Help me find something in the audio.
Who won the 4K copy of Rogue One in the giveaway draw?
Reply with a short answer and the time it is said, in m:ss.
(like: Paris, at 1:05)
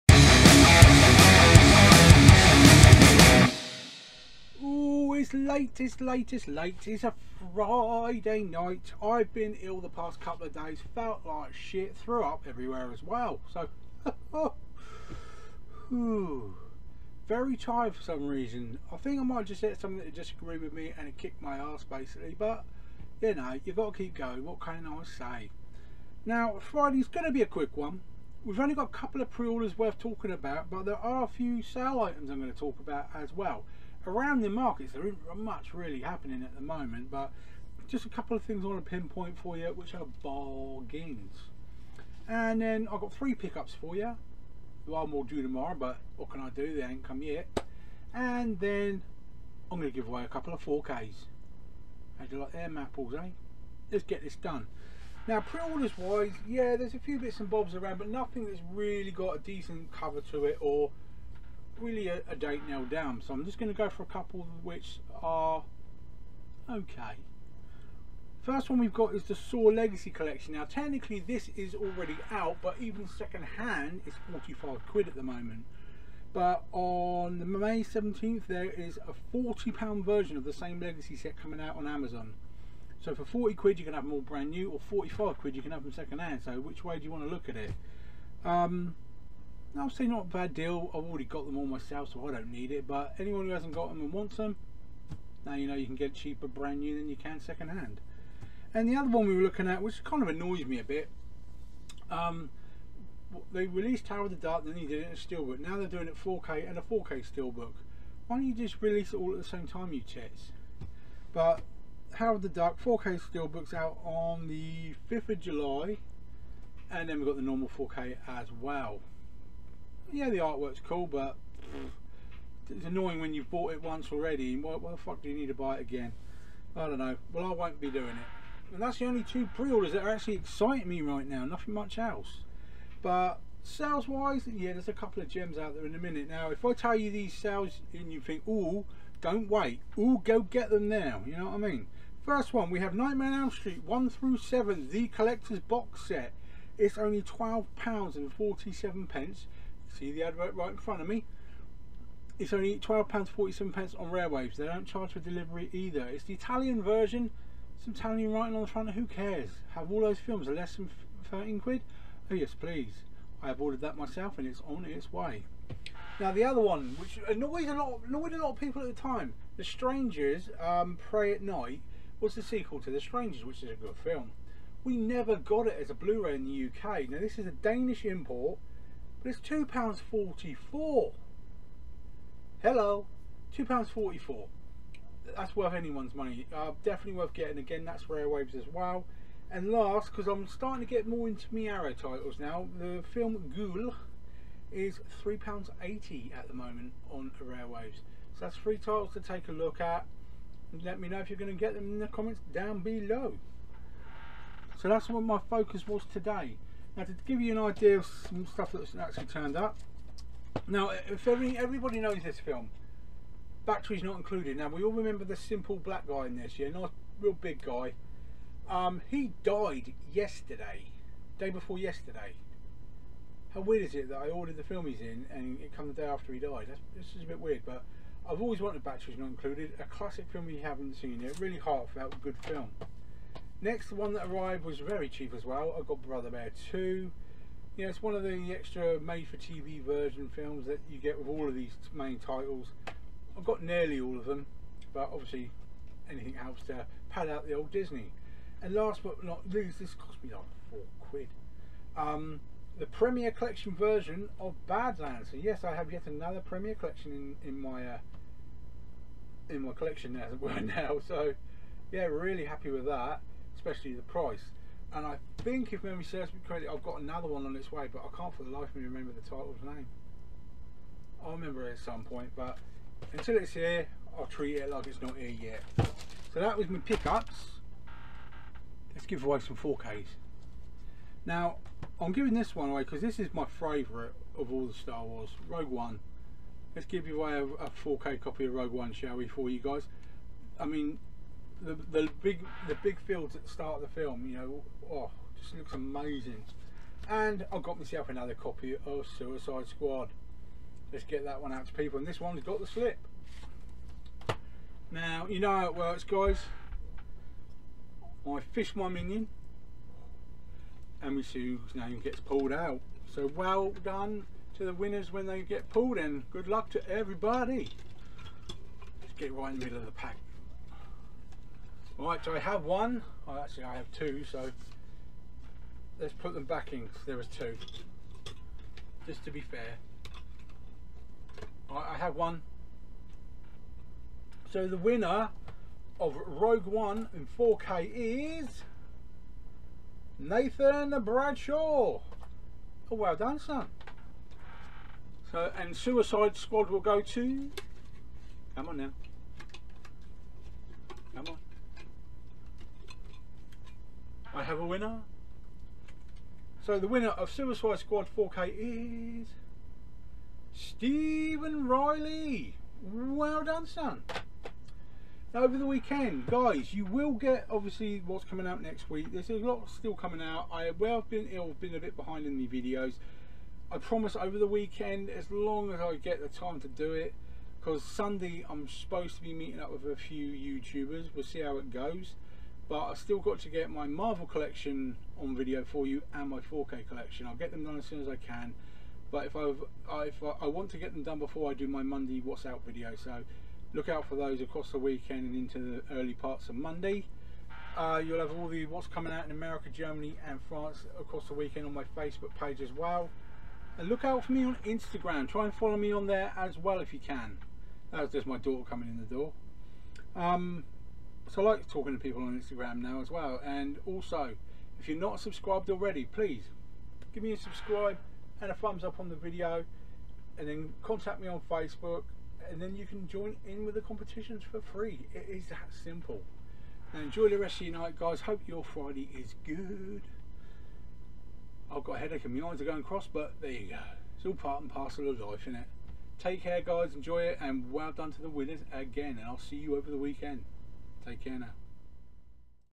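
Nathan Bradshaw, at 5:40.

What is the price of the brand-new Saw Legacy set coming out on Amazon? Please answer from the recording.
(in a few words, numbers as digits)
£40.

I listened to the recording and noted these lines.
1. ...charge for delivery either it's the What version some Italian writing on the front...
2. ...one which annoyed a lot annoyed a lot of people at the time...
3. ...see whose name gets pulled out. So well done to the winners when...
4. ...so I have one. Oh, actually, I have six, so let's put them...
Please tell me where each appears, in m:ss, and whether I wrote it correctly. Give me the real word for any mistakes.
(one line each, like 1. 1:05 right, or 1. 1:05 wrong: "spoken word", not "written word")
1. 2:34 wrong: "Italian", not "What"
2. 2:46 right
3. 5:11 right
4. 5:22 wrong: "two", not "six".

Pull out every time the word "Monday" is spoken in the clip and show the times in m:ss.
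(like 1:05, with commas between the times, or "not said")
6:31, 6:36.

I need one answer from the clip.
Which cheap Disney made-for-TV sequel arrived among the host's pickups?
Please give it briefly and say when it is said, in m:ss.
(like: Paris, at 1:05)
Brother Bear 2, at 3:56.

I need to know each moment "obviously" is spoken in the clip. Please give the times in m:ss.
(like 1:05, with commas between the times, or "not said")
4:05, 6:07.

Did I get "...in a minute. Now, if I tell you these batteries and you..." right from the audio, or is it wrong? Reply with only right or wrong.
wrong.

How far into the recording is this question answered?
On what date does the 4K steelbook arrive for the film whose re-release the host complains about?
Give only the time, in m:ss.
1:55.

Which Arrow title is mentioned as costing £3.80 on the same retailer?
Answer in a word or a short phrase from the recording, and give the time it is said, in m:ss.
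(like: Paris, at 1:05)
Ghoul, at 3:13.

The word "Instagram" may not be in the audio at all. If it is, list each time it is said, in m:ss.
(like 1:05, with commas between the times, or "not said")
6:44, 6:52.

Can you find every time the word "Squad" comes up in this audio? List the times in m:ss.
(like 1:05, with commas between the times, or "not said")
4:59, 5:46, 5:57.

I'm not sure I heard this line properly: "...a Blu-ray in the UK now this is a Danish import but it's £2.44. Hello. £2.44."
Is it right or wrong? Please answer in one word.
right.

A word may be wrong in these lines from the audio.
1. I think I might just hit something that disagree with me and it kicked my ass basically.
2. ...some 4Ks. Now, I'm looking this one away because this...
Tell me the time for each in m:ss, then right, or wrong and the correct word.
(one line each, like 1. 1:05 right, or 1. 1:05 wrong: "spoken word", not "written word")
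1. 0:18 right
2. 4:39 wrong: "giving", not "looking".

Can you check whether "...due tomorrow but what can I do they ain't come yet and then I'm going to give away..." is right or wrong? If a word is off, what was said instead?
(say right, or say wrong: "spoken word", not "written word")
right.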